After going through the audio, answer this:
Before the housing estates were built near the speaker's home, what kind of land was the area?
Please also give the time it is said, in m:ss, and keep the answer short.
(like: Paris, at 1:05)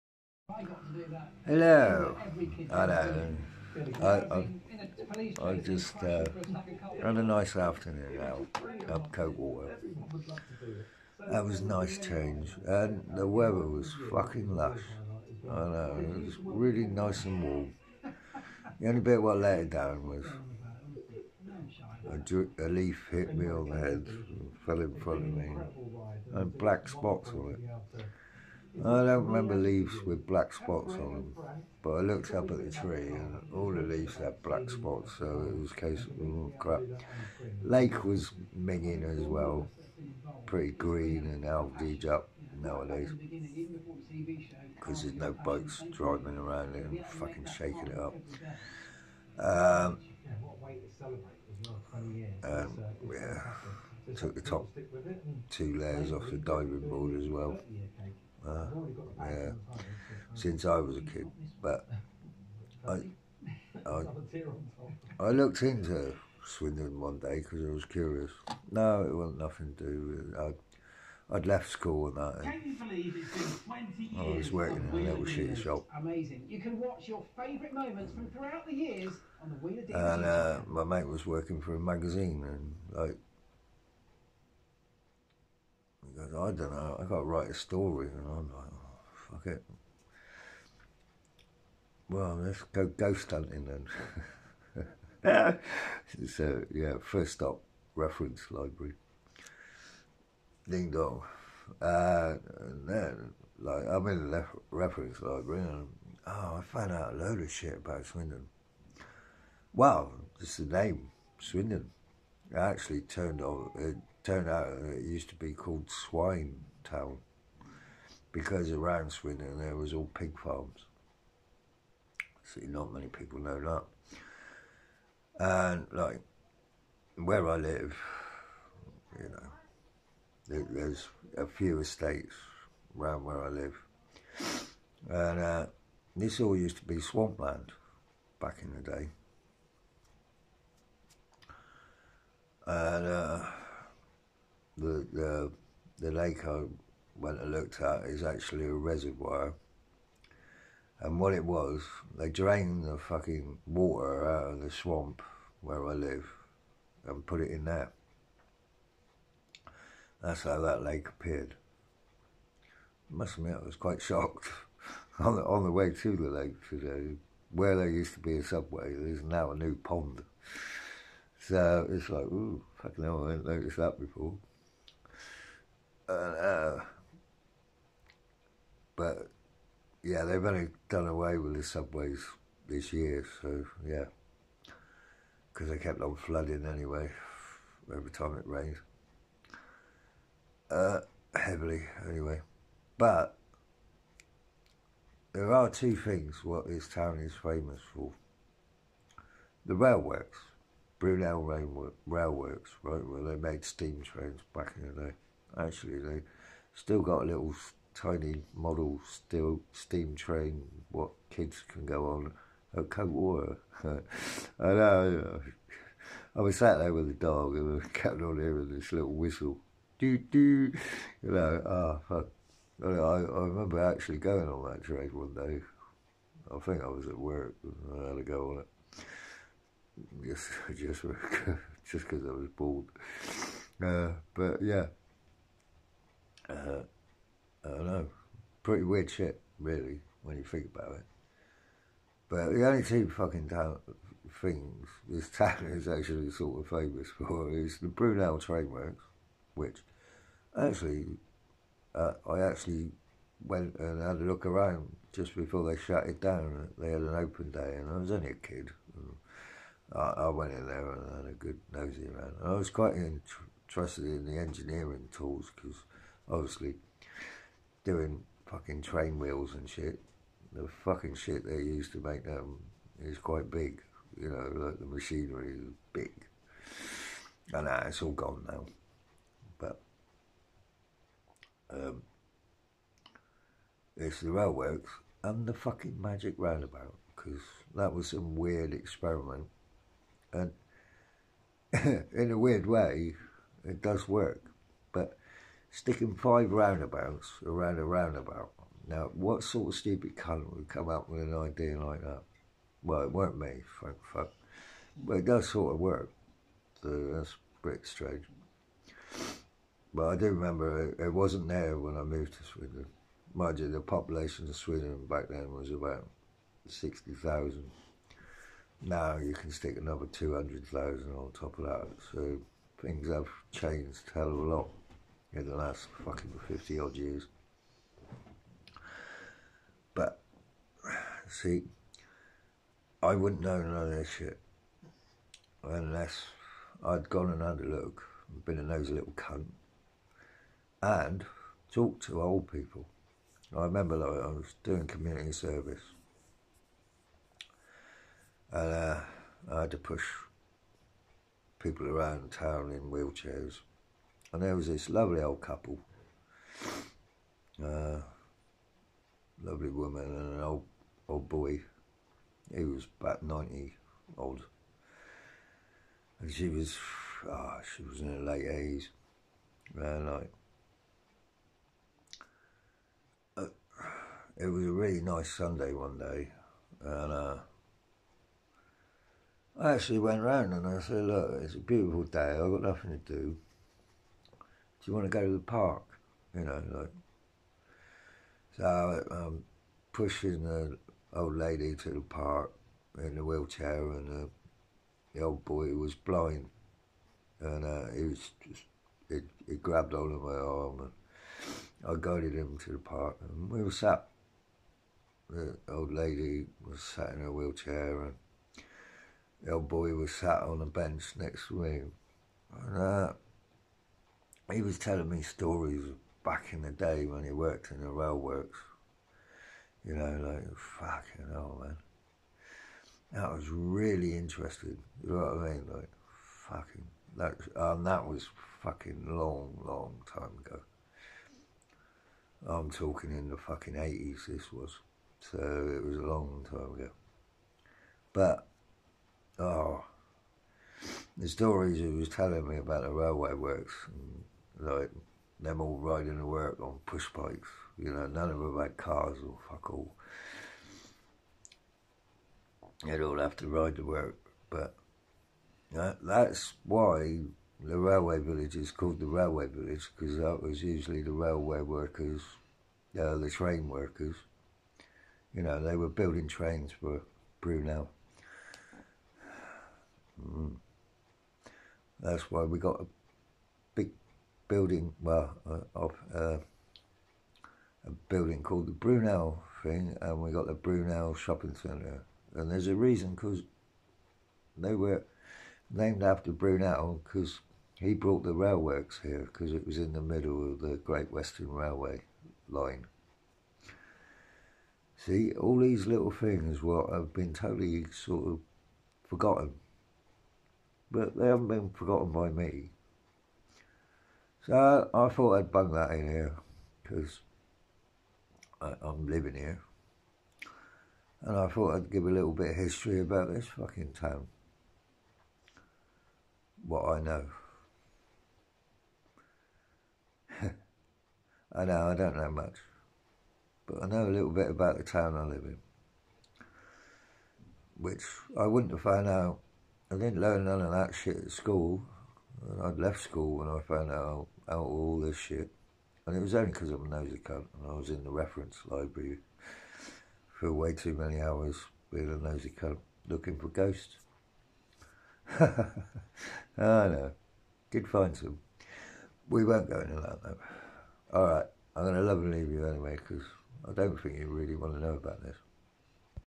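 Swampland, at 2:16.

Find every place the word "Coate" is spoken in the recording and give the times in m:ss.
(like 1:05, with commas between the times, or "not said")
0:09, 3:32.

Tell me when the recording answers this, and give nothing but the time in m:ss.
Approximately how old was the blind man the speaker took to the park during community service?
6:03.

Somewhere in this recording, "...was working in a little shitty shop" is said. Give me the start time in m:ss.
1:14.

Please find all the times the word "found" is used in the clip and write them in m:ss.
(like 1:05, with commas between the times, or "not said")
1:46, 8:48, 8:53.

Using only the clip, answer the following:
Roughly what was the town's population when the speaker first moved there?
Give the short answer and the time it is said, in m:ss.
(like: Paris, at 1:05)
60,000, at 5:16.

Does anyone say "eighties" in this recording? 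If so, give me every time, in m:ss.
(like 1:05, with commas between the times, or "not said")
6:08.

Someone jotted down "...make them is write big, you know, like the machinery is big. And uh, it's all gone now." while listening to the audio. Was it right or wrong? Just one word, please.
wrong.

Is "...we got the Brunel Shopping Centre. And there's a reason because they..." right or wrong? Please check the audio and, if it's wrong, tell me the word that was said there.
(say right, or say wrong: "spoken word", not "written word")
right.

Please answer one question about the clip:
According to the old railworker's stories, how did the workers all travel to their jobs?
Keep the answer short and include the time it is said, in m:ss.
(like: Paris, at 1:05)
Push bikes, at 7:26.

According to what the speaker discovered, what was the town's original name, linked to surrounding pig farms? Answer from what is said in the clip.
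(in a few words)
Swine Town.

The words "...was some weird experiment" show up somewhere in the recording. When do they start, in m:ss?
4:47.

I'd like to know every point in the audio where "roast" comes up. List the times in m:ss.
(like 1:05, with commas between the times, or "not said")
not said.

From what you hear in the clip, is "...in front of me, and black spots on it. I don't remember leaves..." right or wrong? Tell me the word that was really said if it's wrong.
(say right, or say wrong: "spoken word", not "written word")
right.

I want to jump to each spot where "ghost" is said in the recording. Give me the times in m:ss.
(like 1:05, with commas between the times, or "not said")
1:32, 9:03.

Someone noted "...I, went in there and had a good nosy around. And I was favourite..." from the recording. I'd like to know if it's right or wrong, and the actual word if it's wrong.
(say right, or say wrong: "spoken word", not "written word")
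wrong: "quite", not "favourite".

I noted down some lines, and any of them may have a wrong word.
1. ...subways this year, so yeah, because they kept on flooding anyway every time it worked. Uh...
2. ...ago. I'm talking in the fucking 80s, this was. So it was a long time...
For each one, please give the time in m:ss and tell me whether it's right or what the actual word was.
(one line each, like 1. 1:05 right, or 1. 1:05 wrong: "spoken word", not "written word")
1. 3:01 wrong: "rained", not "worked"
2. 7:10 right.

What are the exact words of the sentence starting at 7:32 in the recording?
They'd all have to ride to work.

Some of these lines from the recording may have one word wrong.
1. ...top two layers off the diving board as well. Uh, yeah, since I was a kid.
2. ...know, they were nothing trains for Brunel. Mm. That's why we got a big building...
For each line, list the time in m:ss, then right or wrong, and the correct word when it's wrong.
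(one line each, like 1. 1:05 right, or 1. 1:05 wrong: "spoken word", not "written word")
1. 0:54 right
2. 7:45 wrong: "building", not "nothing".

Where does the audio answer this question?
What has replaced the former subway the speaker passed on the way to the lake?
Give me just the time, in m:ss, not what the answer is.
2:49.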